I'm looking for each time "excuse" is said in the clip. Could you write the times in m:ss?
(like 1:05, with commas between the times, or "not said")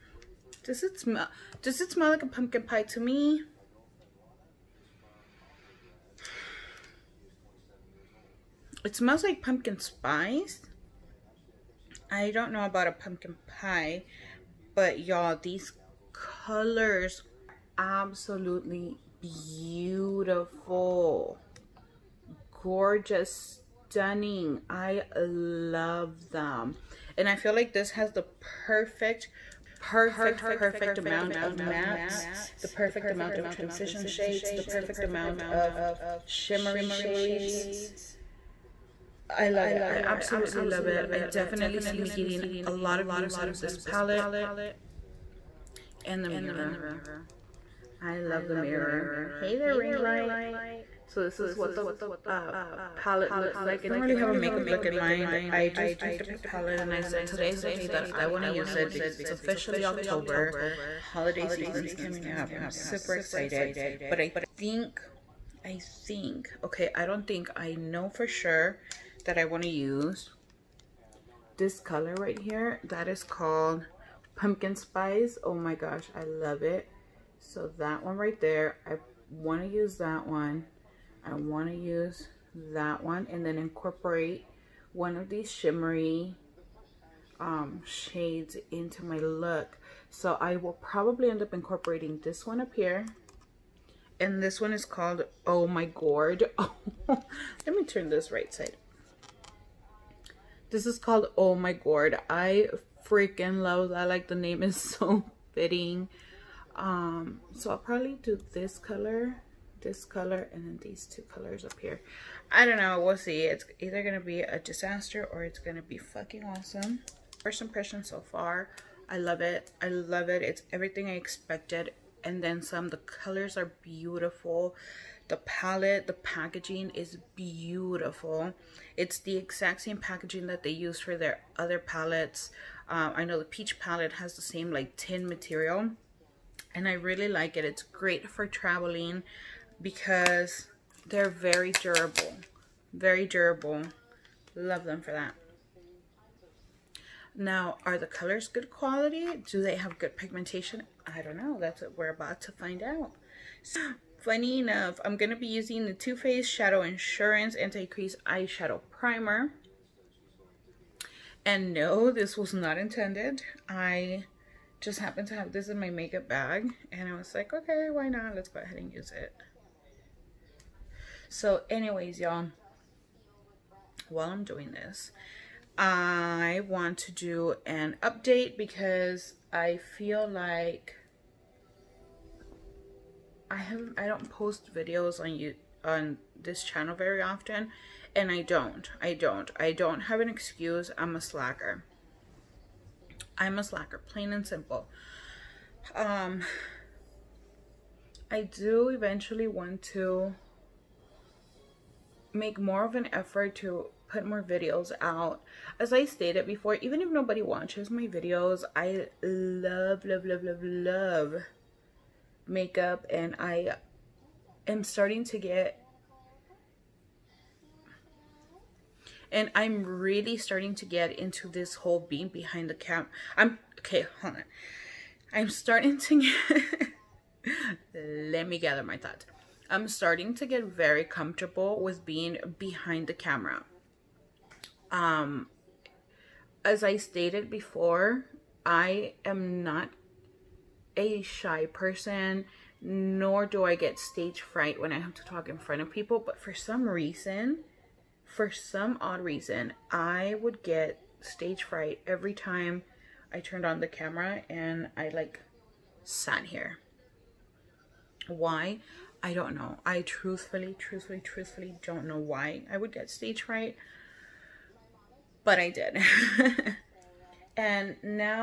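3:10.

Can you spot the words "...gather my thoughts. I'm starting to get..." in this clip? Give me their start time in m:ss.
3:48.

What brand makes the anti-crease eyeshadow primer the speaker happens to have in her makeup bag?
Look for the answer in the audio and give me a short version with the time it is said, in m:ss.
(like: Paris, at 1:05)
Too Faced, at 2:35.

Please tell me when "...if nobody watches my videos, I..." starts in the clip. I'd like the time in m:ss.
3:27.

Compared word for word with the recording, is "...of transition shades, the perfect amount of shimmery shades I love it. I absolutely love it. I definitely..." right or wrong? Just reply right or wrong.
right.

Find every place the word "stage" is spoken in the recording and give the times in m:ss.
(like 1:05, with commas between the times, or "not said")
4:03, 4:11, 4:23.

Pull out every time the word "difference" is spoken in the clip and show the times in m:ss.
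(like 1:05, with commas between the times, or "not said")
not said.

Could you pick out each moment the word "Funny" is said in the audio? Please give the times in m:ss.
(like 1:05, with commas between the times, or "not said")
2:34.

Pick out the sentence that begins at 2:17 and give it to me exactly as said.
It's great for traveling because they're very durable.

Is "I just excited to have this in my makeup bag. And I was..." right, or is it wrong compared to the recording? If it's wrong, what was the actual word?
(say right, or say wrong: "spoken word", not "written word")
wrong: "happened", not "excited".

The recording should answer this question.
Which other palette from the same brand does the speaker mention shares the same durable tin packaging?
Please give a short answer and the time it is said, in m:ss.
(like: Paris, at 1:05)
the peach palette, at 2:13.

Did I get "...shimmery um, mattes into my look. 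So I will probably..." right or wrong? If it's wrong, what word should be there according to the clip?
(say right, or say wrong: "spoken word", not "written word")
wrong: "shades", not "mattes".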